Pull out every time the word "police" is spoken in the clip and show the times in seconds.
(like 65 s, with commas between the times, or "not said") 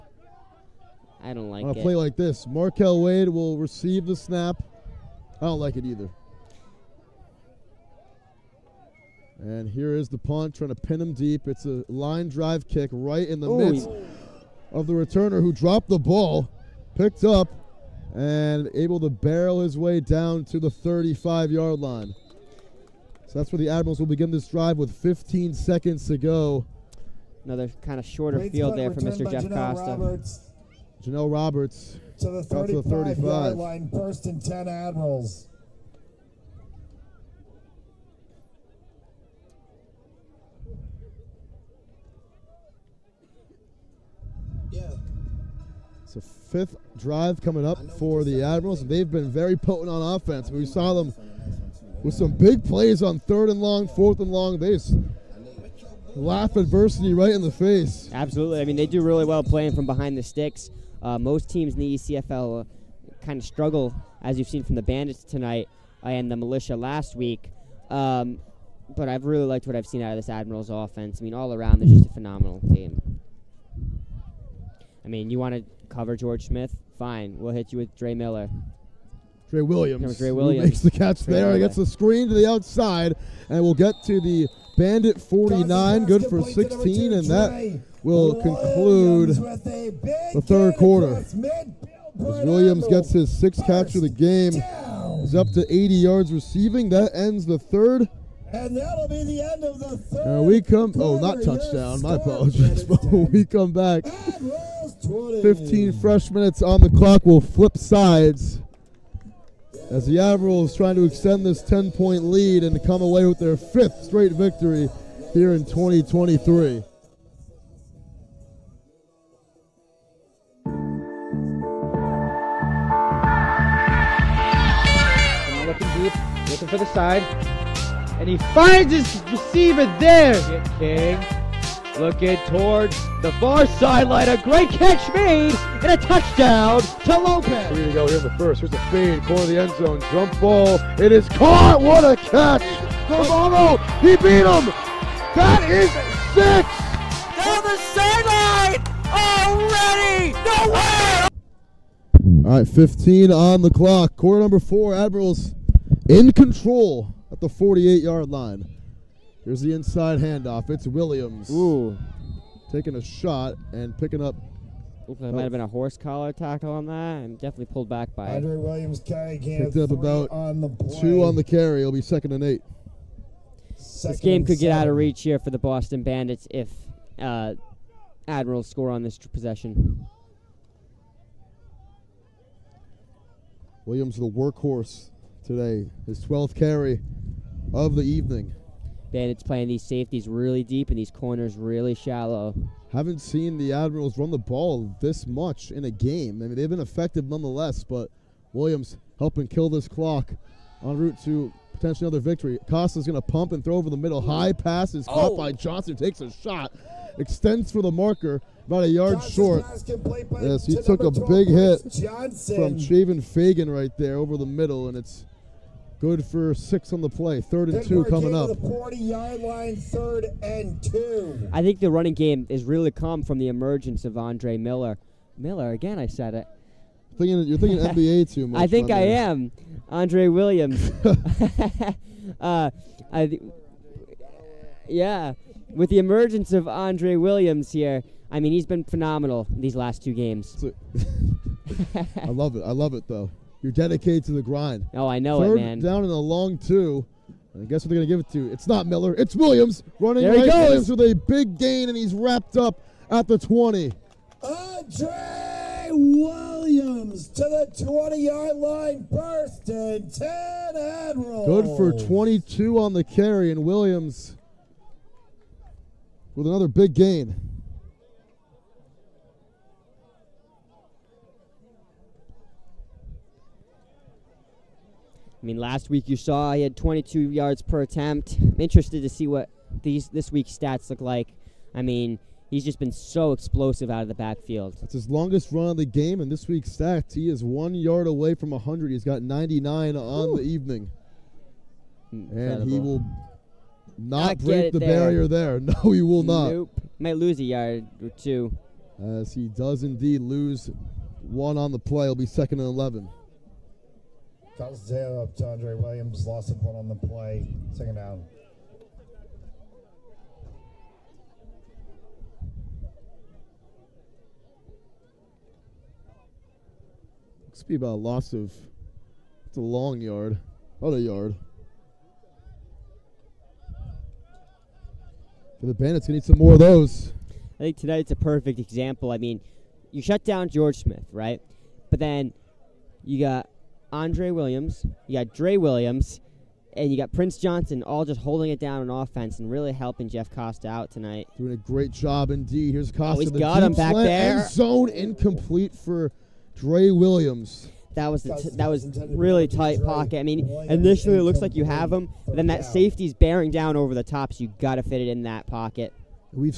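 not said.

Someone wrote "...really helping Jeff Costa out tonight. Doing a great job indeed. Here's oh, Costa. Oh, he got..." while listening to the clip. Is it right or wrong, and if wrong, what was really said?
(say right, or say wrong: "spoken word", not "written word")
right.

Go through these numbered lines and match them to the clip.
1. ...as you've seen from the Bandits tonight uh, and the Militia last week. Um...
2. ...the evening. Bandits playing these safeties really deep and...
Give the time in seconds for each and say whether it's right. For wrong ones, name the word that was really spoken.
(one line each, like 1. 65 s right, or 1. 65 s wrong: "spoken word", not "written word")
1. 64 s right
2. 187 s right.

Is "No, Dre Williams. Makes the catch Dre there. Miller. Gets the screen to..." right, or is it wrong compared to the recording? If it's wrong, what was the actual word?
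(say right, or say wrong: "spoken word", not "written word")
right.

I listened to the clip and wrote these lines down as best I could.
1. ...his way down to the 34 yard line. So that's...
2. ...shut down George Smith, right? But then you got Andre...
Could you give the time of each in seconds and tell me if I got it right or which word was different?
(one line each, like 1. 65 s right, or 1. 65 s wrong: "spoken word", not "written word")
1. 19 s wrong: "35", not "34"
2. 330 s right.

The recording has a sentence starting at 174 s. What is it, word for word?
get out of reach here for the Boston Bandits if uh, Admirals score on this possession.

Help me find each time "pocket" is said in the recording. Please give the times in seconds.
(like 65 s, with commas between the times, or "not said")
349 s, 355 s.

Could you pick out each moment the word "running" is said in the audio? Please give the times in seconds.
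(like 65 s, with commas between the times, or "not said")
221 s, 249 s.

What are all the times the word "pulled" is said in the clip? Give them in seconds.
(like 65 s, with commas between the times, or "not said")
167 s.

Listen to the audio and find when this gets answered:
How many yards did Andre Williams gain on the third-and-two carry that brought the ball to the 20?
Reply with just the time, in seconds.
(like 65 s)
261 s.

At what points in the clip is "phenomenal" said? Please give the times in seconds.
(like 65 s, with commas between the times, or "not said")
72 s, 238 s.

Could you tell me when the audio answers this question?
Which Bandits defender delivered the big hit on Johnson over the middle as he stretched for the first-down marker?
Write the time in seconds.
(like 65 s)
212 s.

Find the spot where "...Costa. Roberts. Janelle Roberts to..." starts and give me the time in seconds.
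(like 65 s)
29 s.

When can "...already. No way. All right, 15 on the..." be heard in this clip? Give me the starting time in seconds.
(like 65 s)
149 s.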